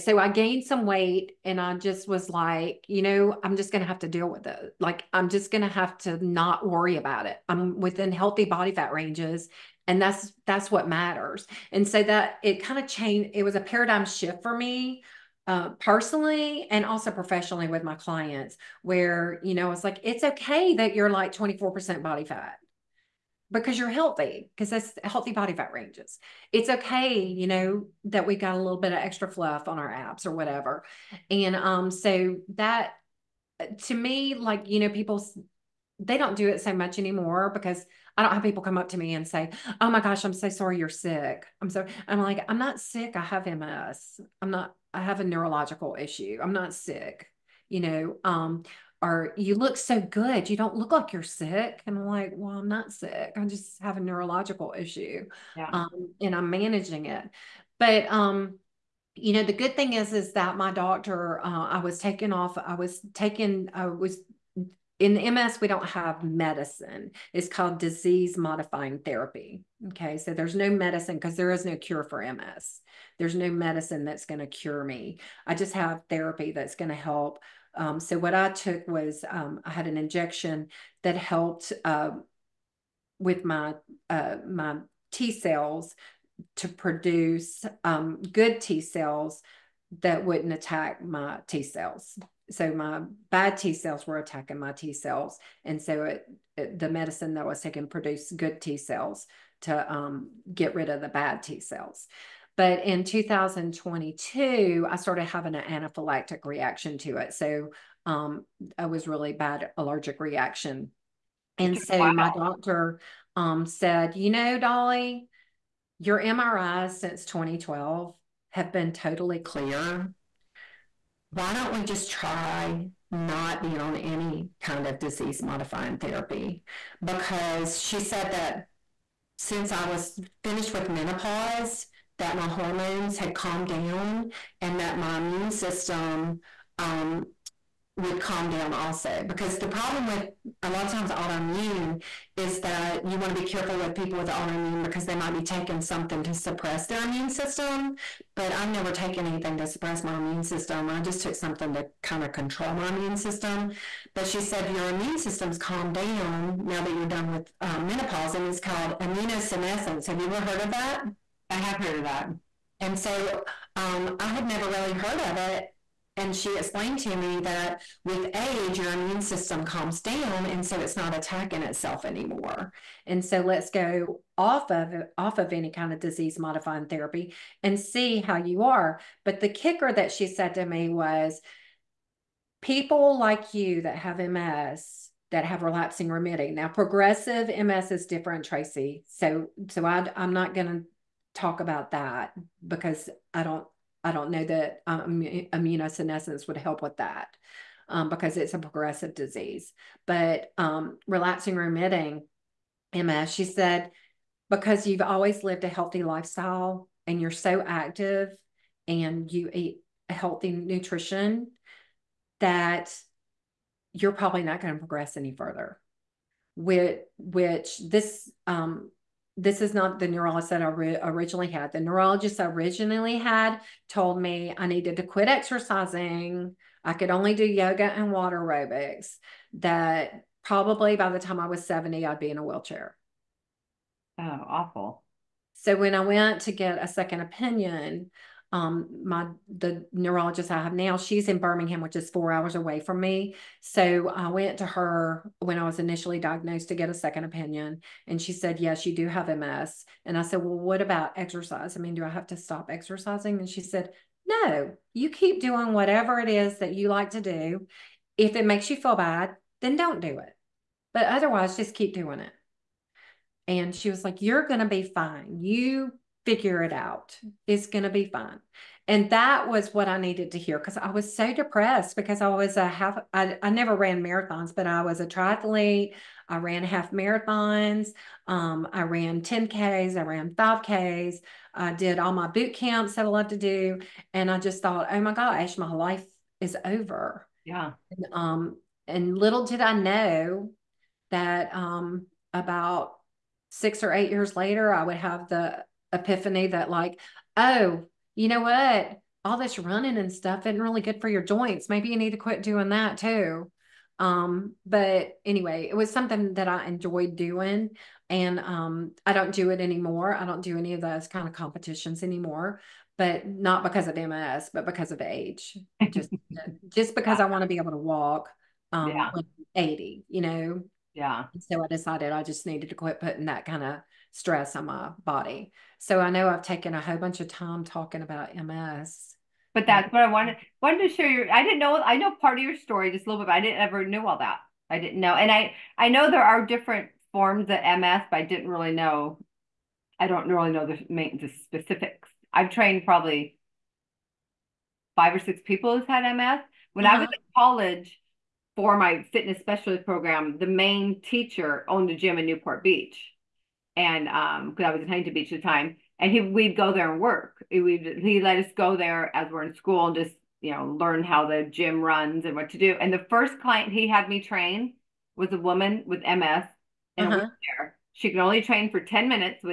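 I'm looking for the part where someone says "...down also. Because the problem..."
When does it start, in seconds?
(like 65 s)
138 s.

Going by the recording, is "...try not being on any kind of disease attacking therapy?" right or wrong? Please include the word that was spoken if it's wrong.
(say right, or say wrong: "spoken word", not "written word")
wrong: "modifying", not "attacking".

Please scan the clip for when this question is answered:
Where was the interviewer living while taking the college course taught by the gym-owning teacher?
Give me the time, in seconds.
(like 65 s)
354 s.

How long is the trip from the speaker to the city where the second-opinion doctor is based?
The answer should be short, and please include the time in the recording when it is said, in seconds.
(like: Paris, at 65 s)
4 hours, at 242 s.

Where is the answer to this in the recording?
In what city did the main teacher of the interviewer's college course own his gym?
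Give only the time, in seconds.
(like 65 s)
352 s.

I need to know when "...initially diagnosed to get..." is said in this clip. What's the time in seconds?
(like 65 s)
245 s.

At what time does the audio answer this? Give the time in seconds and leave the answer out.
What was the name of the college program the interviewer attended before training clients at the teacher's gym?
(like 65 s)
349 s.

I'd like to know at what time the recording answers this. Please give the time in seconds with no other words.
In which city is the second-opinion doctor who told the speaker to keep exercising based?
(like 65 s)
241 s.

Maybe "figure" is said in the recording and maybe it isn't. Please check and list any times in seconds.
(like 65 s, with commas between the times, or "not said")
266 s.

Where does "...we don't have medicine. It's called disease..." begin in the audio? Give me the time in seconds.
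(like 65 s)
65 s.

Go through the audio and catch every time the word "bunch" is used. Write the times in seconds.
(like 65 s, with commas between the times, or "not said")
326 s.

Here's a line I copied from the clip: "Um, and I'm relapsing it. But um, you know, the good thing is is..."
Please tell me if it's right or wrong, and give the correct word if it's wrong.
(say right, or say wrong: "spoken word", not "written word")
wrong: "managing", not "relapsing".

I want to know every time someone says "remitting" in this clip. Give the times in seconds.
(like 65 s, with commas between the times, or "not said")
186 s, 201 s.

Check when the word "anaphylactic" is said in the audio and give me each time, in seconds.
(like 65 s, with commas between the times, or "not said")
105 s.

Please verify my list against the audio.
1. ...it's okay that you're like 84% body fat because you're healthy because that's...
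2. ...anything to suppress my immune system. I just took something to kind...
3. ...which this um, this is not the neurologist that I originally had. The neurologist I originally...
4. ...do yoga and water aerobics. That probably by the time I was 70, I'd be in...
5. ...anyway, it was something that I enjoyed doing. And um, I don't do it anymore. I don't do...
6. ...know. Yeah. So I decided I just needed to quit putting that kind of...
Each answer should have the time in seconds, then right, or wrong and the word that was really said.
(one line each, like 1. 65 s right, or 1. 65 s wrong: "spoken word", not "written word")
1. 20 s wrong: "24", not "84"
2. 149 s right
3. 217 s right
4. 227 s right
5. 305 s right
6. 320 s right.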